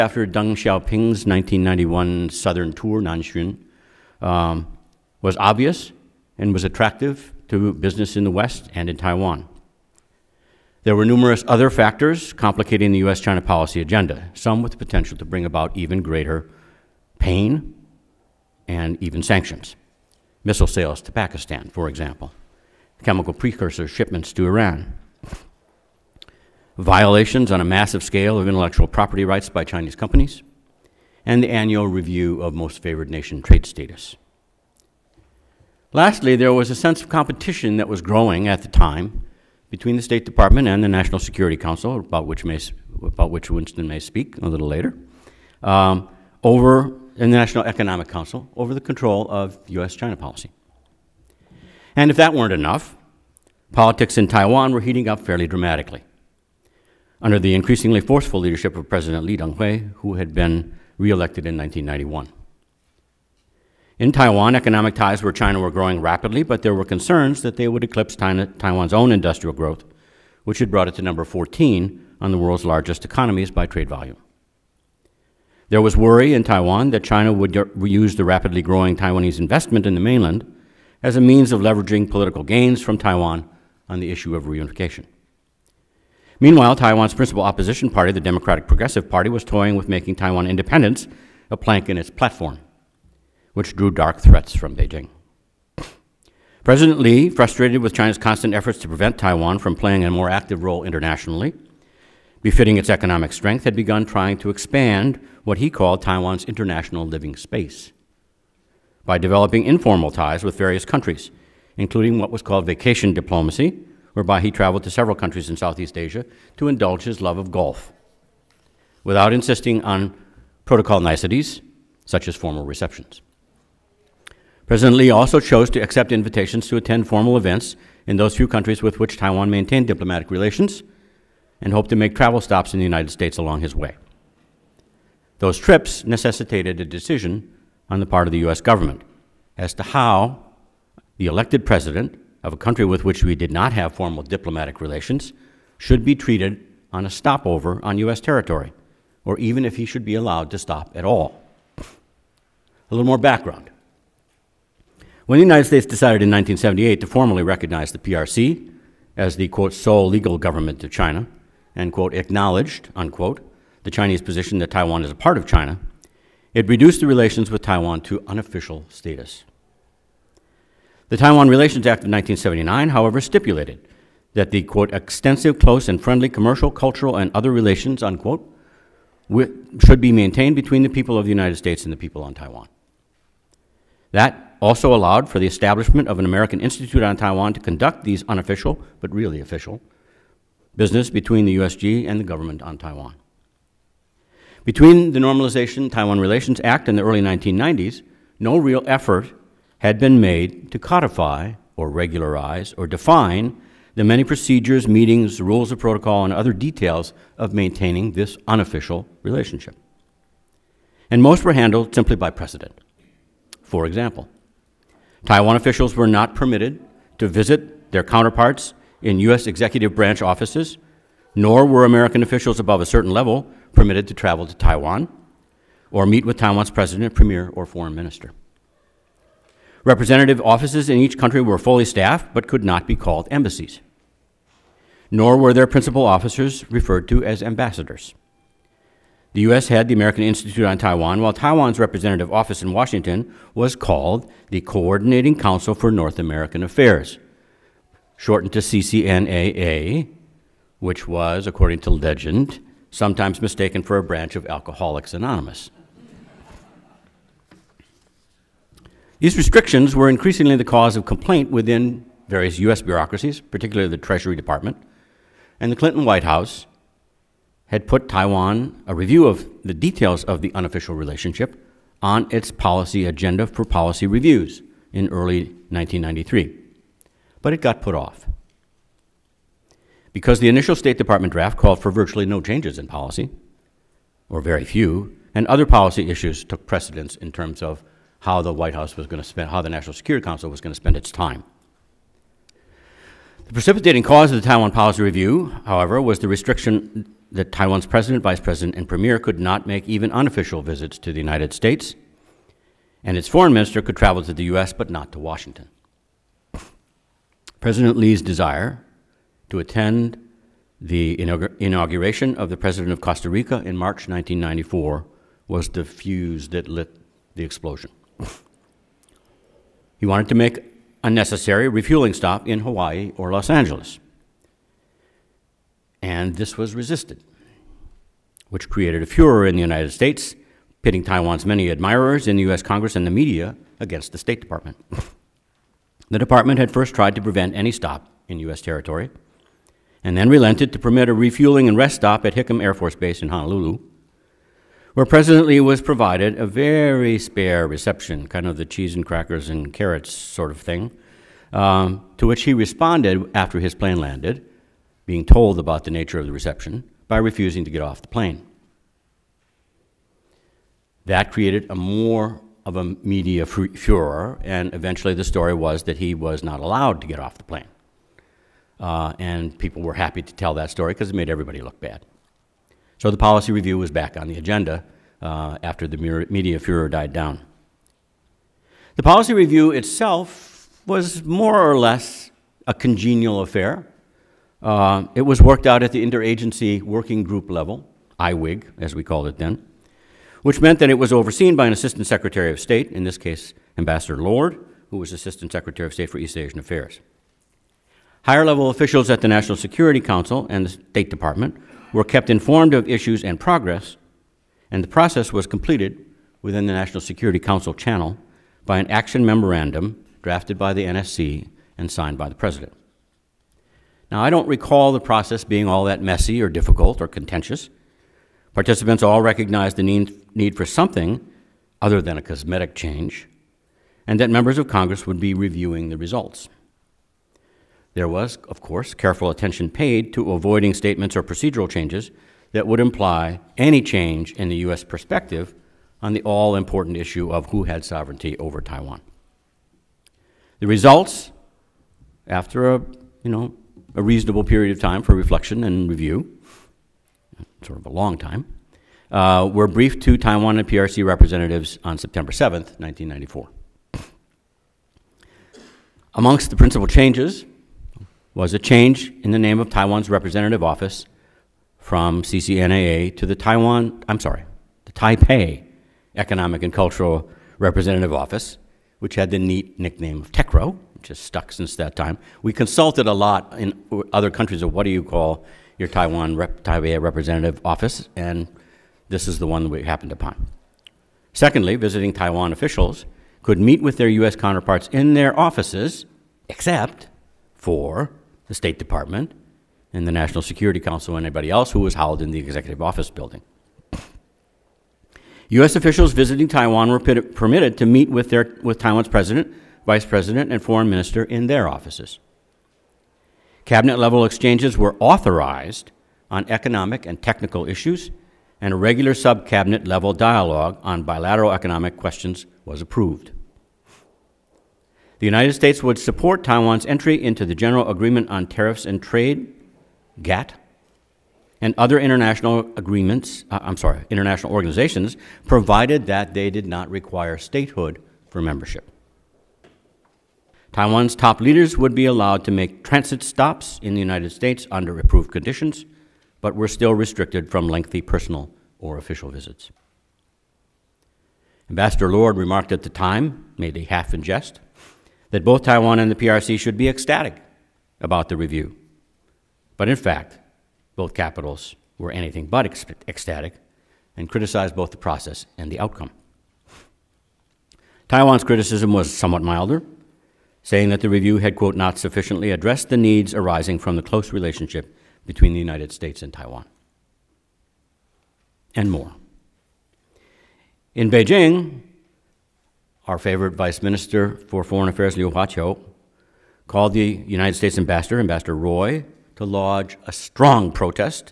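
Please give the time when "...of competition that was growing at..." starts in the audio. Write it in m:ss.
0:37.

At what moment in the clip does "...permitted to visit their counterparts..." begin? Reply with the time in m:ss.
3:36.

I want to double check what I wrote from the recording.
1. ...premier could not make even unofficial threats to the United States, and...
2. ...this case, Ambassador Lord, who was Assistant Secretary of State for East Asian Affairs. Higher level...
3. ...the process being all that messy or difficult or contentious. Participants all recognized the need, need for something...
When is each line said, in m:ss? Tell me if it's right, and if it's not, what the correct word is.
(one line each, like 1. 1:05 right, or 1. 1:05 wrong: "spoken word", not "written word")
1. 4:58 wrong: "visits", not "threats"
2. 6:33 right
3. 6:54 right.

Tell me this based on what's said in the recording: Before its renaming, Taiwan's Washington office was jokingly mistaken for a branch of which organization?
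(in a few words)
Alcoholics Anonymous.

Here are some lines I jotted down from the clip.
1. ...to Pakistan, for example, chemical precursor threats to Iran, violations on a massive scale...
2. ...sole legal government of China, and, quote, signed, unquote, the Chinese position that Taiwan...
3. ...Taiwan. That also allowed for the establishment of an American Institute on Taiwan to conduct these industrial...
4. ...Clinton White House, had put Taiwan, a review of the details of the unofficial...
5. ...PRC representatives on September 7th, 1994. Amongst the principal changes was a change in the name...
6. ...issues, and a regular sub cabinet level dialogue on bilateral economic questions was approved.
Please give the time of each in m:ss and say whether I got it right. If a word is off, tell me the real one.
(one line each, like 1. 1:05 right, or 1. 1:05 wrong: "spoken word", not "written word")
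1. 0:21 wrong: "shipments", not "threats"
2. 2:39 wrong: "acknowledged", not "signed"
3. 3:02 wrong: "unofficial", not "industrial"
4. 4:25 right
5. 7:30 right
6. 8:27 right.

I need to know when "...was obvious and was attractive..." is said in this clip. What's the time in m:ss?
0:05.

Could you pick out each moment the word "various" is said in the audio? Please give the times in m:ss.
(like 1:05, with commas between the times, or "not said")
1:50, 4:22.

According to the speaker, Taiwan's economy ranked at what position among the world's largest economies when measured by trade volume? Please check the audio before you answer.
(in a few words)
14.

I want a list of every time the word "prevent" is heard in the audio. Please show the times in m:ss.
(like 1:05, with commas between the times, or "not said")
1:38, 5:37.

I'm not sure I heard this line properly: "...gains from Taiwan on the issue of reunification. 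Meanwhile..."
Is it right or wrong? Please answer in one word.
right.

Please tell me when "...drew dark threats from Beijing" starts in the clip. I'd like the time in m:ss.
1:33.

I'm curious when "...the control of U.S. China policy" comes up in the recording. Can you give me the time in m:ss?
0:48.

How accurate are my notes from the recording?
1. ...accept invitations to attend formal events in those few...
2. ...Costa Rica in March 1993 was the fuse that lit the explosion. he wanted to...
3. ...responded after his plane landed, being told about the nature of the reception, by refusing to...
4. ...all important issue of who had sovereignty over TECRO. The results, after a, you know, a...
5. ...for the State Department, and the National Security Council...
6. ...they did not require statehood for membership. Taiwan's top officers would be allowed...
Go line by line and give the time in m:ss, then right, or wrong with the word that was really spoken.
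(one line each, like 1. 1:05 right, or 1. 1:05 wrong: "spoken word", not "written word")
1. 2:05 right
2. 5:13 wrong: "1994", not "1993"
3. 5:52 right
4. 7:16 wrong: "Taiwan", not "TECRO"
5. 8:07 right
6. 8:46 wrong: "leaders", not "officers".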